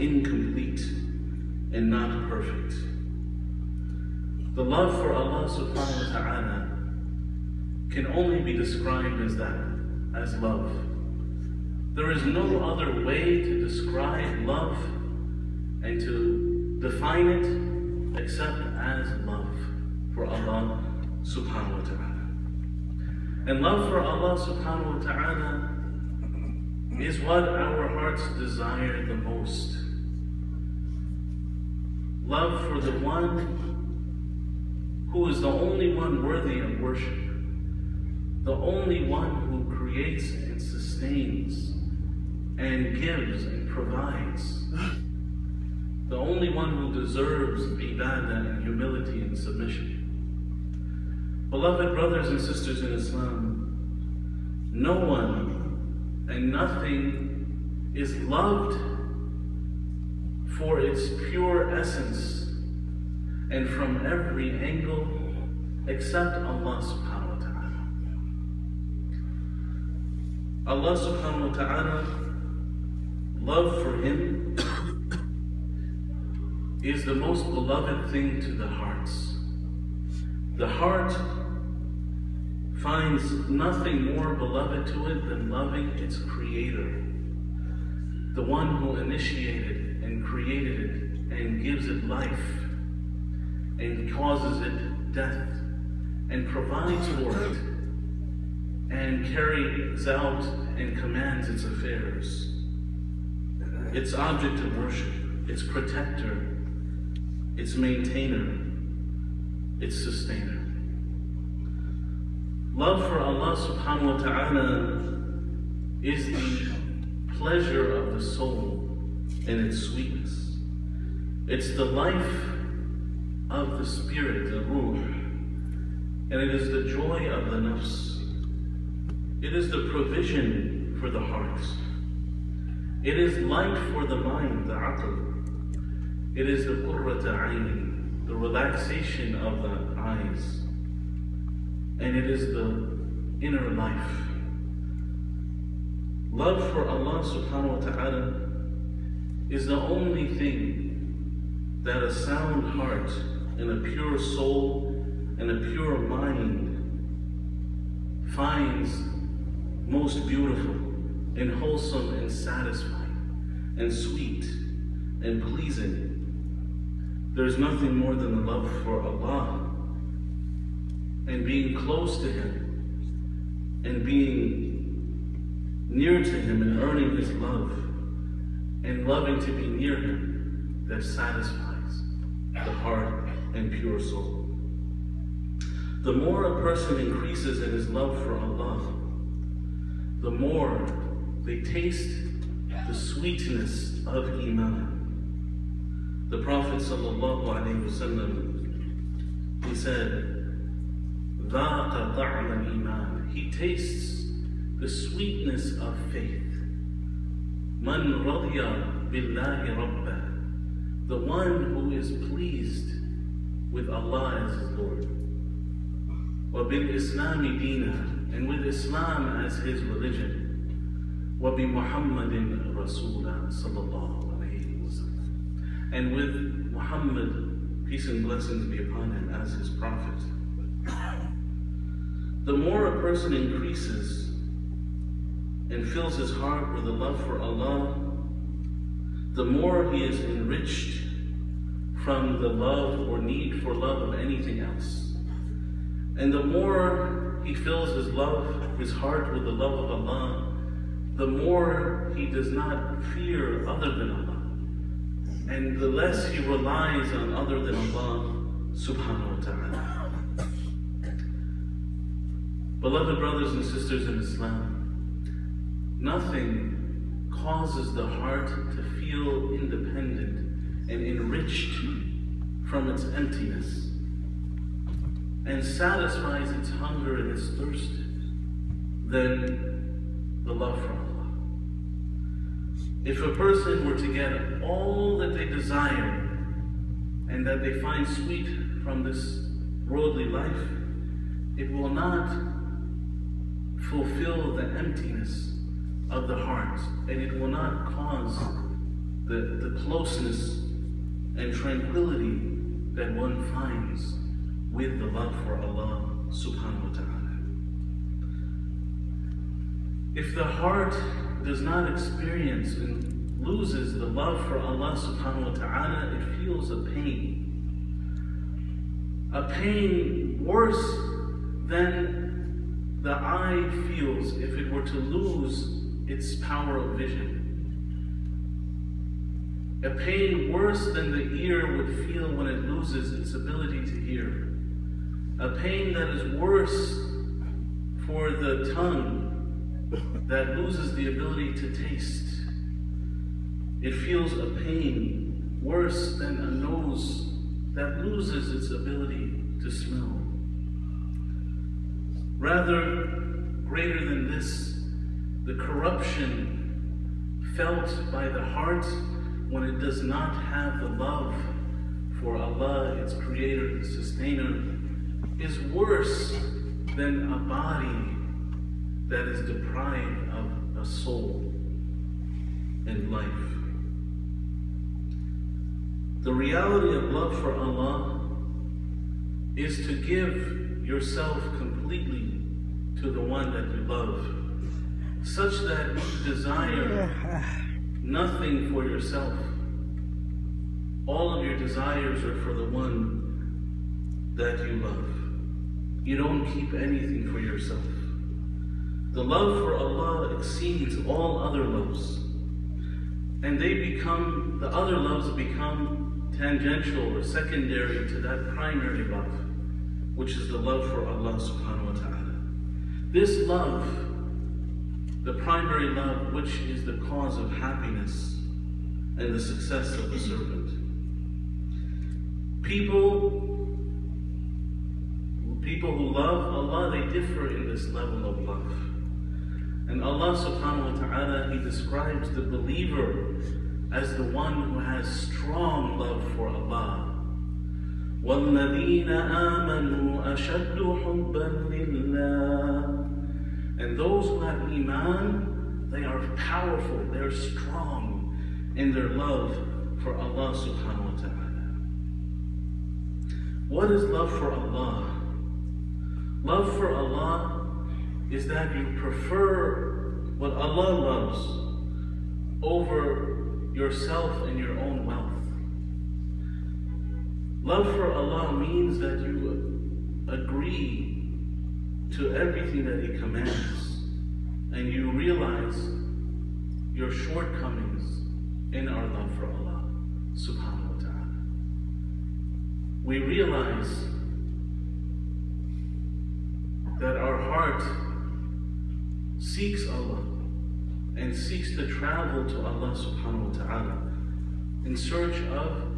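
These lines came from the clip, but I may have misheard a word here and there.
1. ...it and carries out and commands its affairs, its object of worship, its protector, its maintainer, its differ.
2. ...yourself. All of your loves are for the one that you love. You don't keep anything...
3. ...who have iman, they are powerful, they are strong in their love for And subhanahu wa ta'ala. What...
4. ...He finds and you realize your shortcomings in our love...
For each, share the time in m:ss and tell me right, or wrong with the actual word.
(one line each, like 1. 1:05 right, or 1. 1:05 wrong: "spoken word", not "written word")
1. 1:37 wrong: "sustainer", not "differ"
2. 6:28 wrong: "desires", not "loves"
3. 7:24 wrong: "Allah", not "And"
4. 7:53 wrong: "commands", not "finds".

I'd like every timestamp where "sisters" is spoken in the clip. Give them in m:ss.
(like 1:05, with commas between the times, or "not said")
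0:52, 4:23.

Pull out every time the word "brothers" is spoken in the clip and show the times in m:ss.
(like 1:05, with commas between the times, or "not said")
0:51, 4:23.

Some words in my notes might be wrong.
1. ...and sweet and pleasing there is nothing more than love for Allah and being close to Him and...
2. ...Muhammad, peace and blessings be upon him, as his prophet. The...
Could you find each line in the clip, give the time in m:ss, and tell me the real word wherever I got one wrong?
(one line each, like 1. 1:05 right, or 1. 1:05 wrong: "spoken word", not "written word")
1. 2:43 right
2. 3:46 right.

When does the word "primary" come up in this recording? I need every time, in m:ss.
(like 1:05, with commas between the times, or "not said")
6:48, 6:55.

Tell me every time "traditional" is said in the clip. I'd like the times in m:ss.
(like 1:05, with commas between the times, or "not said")
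not said.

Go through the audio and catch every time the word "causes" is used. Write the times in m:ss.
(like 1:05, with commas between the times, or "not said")
1:34, 4:27, 4:57, 6:56.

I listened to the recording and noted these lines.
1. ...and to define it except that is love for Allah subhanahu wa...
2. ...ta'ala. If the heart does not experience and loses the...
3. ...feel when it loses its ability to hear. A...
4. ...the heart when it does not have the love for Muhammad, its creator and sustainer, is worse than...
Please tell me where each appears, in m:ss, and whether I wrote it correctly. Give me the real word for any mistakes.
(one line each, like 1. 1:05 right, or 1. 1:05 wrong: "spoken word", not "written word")
1. 0:15 right
2. 5:06 right
3. 5:32 right
4. 5:58 wrong: "Allah", not "Muhammad".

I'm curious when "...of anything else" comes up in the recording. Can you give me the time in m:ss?
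4:04.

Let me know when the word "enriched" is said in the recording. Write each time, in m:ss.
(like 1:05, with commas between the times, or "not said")
4:00, 4:31.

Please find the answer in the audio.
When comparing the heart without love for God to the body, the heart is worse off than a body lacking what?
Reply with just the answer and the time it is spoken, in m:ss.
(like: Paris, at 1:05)
A soul and life, at 6:10.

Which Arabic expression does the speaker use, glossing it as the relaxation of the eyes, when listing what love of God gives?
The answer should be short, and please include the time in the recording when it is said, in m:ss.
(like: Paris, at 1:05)
qurrata ayni, at 2:16.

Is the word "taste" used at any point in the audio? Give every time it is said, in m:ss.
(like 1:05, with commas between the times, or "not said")
3:11, 3:23, 5:41.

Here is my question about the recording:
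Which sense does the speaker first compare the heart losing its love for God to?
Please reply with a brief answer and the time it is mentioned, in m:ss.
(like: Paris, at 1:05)
Vision, at 5:26.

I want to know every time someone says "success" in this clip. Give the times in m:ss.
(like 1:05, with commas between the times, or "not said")
6:59.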